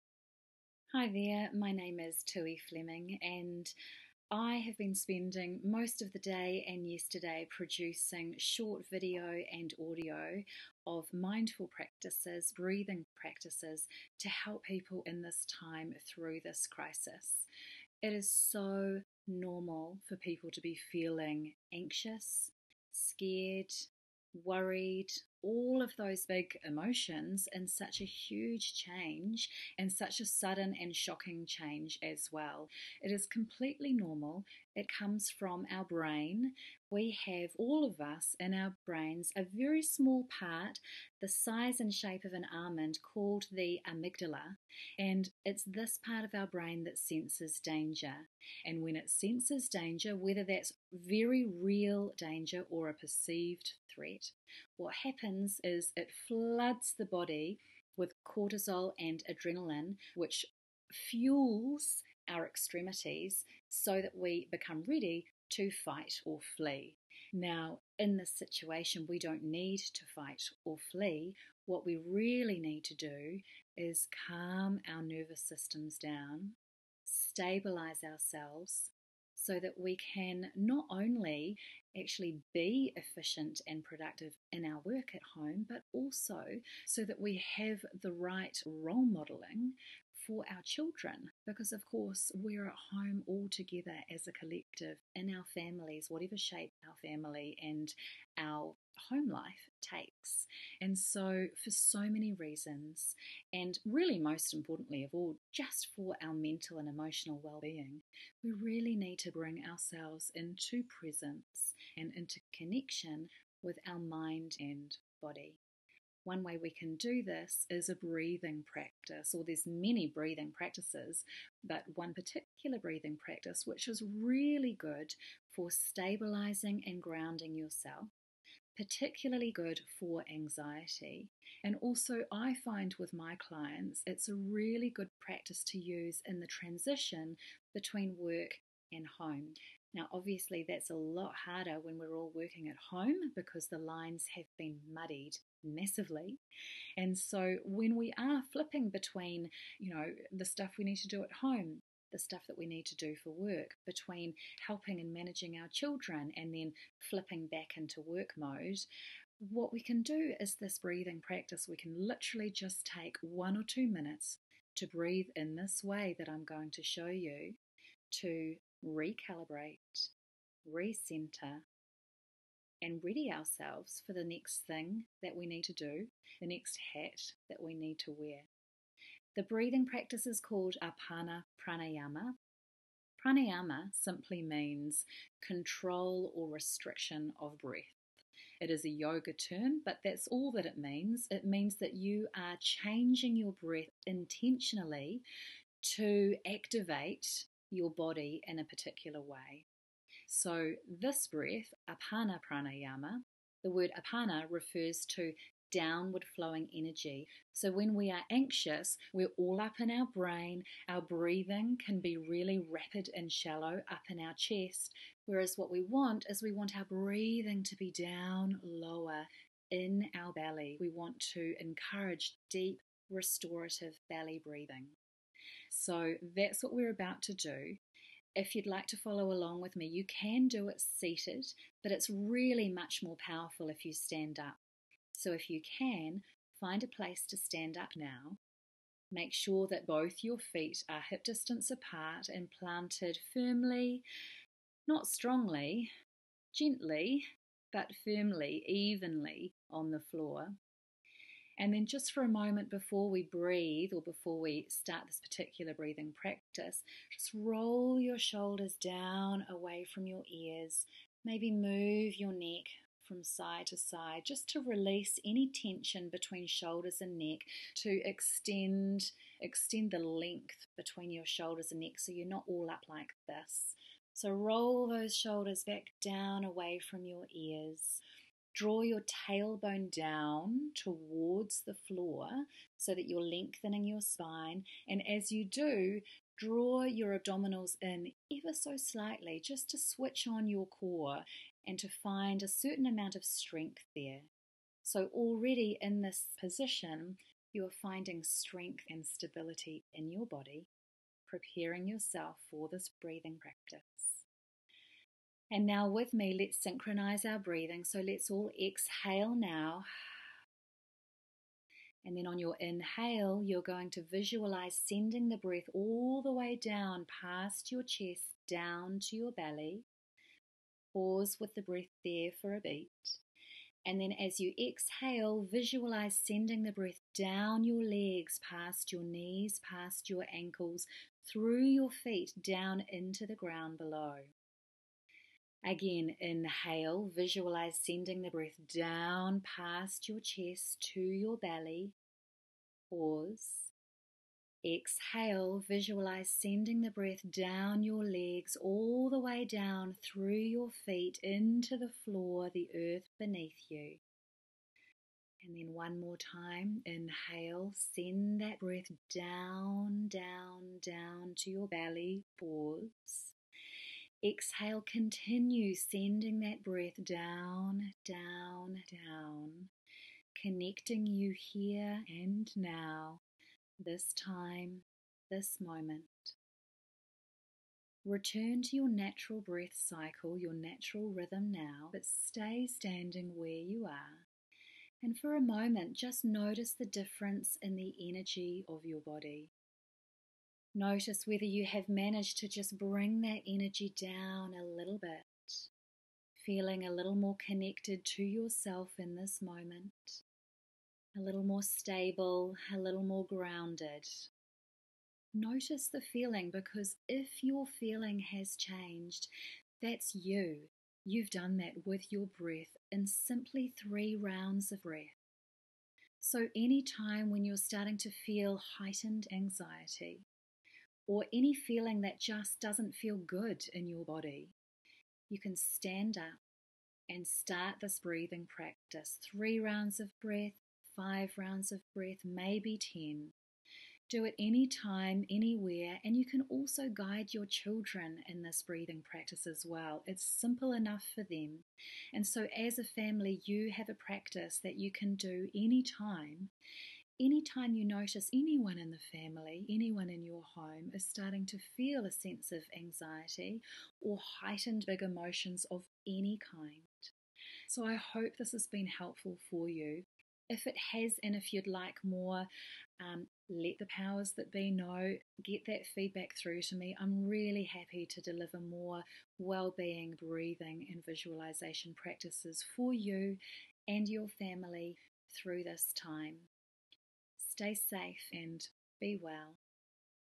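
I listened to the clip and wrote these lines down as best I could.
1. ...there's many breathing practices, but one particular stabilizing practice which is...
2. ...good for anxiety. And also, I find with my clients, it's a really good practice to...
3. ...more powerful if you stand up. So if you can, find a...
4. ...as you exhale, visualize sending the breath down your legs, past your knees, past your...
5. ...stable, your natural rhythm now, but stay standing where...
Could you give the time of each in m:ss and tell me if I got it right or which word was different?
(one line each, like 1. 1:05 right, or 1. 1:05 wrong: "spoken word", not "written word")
1. 1:59 wrong: "breathing", not "stabilizing"
2. 2:09 right
3. 3:53 right
4. 5:24 right
5. 6:19 wrong: "cycle", not "stable".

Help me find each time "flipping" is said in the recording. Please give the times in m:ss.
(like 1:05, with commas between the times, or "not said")
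2:28, 2:37.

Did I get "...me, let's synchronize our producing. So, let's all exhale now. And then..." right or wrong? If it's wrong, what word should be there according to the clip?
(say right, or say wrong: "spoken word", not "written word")
wrong: "breathing", not "producing".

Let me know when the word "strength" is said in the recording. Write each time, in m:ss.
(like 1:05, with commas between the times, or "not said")
4:53, 4:58.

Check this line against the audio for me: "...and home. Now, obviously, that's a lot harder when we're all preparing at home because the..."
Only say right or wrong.
wrong.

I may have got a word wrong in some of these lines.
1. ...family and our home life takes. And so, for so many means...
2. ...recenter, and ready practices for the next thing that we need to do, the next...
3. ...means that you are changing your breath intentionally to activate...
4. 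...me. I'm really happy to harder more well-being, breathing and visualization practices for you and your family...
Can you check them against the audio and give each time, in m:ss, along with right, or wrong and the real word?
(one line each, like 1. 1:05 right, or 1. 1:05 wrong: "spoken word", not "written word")
1. 1:37 wrong: "reasons", not "means"
2. 2:50 wrong: "ourselves", not "practices"
3. 3:11 right
4. 7:46 wrong: "deliver", not "harder".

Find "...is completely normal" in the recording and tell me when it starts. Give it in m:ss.
0:33.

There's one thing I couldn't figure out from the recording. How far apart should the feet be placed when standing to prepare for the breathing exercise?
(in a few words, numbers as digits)
hip distance.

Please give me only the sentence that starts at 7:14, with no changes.
Do it any time, anywhere, and you can also guide your children in this breathing practice as well.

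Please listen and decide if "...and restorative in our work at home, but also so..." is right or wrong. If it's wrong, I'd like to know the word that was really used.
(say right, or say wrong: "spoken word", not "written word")
wrong: "productive", not "restorative".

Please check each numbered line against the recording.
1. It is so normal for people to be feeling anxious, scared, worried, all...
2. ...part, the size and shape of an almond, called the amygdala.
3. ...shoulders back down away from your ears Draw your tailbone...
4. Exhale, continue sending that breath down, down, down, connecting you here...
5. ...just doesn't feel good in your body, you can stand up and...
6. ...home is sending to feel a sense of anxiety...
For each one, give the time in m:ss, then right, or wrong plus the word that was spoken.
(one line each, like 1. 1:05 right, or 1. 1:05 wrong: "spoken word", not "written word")
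1. 0:18 right
2. 0:40 right
3. 4:35 right
4. 6:04 right
5. 7:02 right
6. 7:30 wrong: "starting", not "sending".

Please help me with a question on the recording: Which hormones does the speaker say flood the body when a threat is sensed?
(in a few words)
cortisol.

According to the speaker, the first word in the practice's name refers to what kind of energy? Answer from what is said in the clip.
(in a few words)
downward flowing energy.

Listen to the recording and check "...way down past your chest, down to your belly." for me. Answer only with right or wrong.
right.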